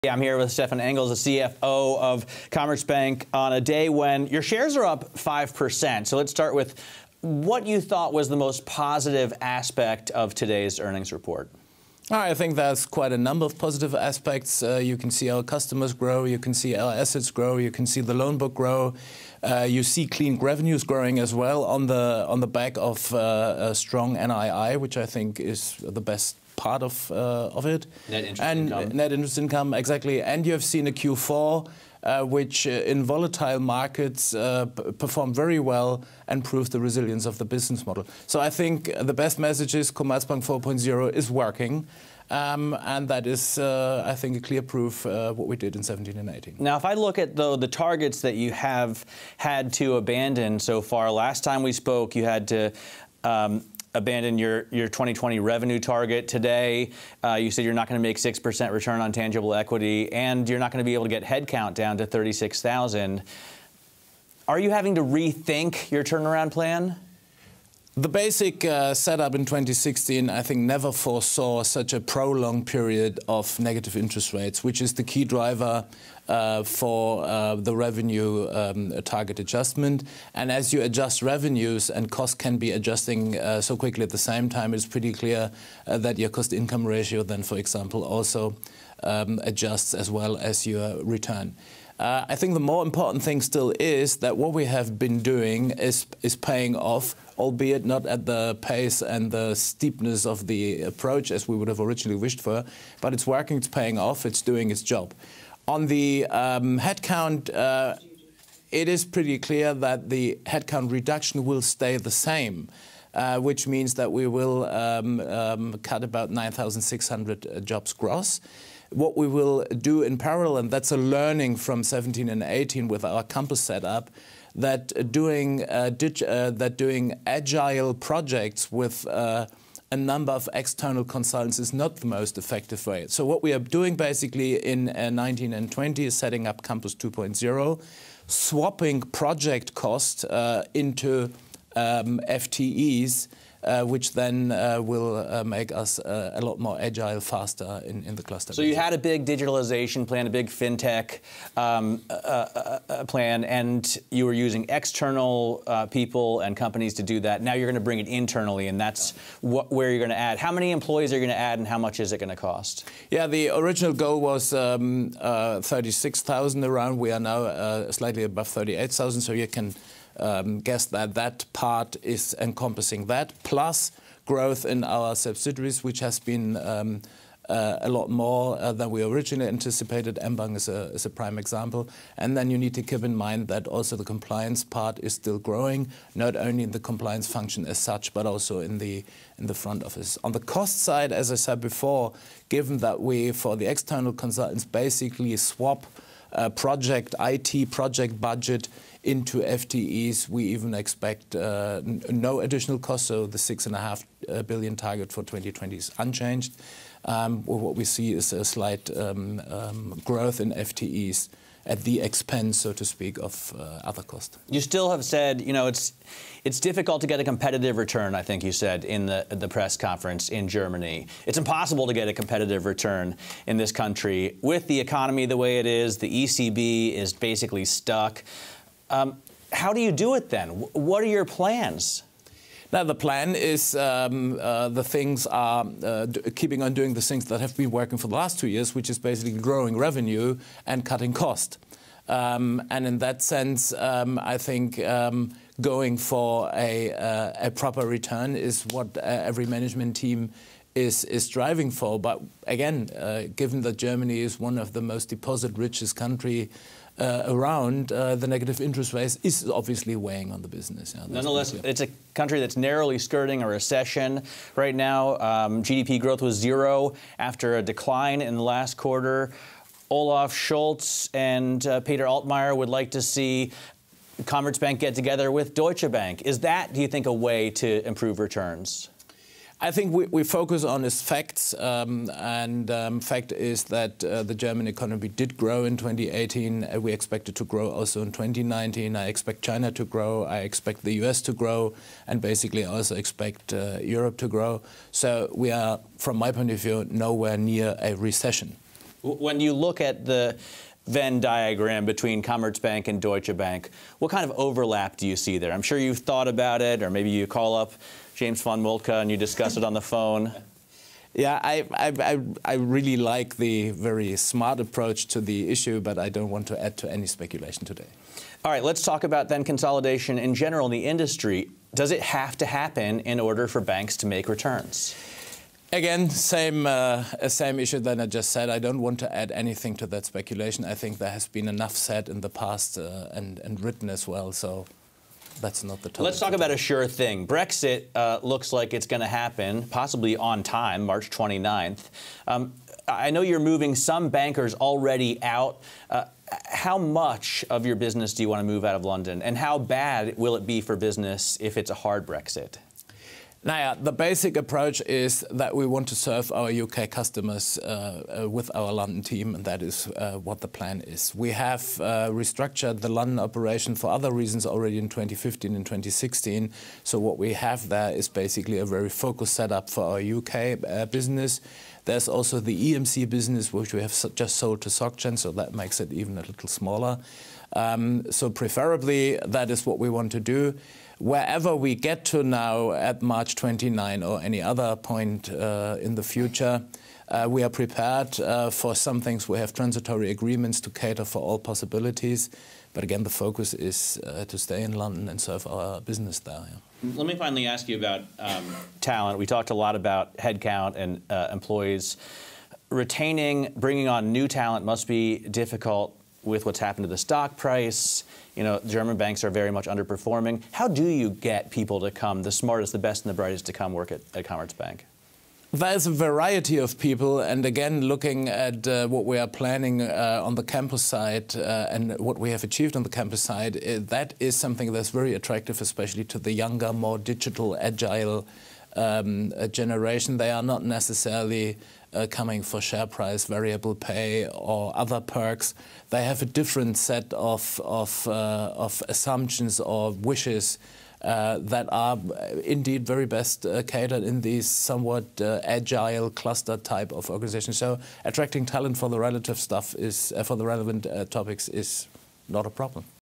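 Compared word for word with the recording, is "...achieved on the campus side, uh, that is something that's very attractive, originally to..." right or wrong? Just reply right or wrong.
wrong.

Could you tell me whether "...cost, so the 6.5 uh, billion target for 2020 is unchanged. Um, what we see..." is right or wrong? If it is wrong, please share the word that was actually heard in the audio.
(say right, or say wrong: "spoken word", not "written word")
right.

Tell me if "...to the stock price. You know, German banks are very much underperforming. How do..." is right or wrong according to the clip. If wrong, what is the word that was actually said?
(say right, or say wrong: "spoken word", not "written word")
right.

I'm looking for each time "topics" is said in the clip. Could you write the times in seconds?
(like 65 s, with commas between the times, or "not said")
451 s.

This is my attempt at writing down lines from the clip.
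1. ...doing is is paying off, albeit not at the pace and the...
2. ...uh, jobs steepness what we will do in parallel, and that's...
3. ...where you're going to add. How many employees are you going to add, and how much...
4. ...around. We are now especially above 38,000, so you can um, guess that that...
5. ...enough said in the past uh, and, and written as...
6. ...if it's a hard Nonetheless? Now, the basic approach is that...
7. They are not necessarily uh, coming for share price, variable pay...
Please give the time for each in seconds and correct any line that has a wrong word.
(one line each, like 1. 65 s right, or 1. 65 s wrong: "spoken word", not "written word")
1. 95 s right
2. 117 s wrong: "gross", not "steepness"
3. 159 s right
4. 166 s wrong: "slightly", not "especially"
5. 331 s right
6. 351 s wrong: "Brexit", not "Nonetheless"
7. 430 s right.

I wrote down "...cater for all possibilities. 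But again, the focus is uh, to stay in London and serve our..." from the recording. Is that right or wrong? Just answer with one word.
right.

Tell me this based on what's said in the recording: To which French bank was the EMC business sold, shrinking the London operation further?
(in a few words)
SocGen.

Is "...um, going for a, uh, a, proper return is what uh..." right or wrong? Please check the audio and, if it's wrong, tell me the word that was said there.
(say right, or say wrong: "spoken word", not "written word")
right.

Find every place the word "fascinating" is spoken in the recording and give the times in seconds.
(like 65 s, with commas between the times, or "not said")
not said.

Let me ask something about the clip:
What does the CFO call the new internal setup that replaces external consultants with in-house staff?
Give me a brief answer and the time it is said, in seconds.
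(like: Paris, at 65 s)
Campus 2.0, at 136 s.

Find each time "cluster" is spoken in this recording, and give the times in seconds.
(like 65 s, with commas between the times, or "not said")
148 s, 446 s.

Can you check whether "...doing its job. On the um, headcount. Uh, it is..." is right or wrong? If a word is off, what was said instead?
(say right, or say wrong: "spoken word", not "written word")
right.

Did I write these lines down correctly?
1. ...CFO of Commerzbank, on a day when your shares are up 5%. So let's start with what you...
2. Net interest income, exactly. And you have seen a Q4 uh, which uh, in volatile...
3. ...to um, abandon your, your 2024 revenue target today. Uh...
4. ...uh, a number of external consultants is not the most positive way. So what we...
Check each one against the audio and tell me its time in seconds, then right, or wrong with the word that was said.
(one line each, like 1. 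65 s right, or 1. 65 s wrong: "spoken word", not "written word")
1. 1 s right
2. 28 s right
3. 52 s wrong: "2020", not "2024"
4. 129 s wrong: "effective", not "positive".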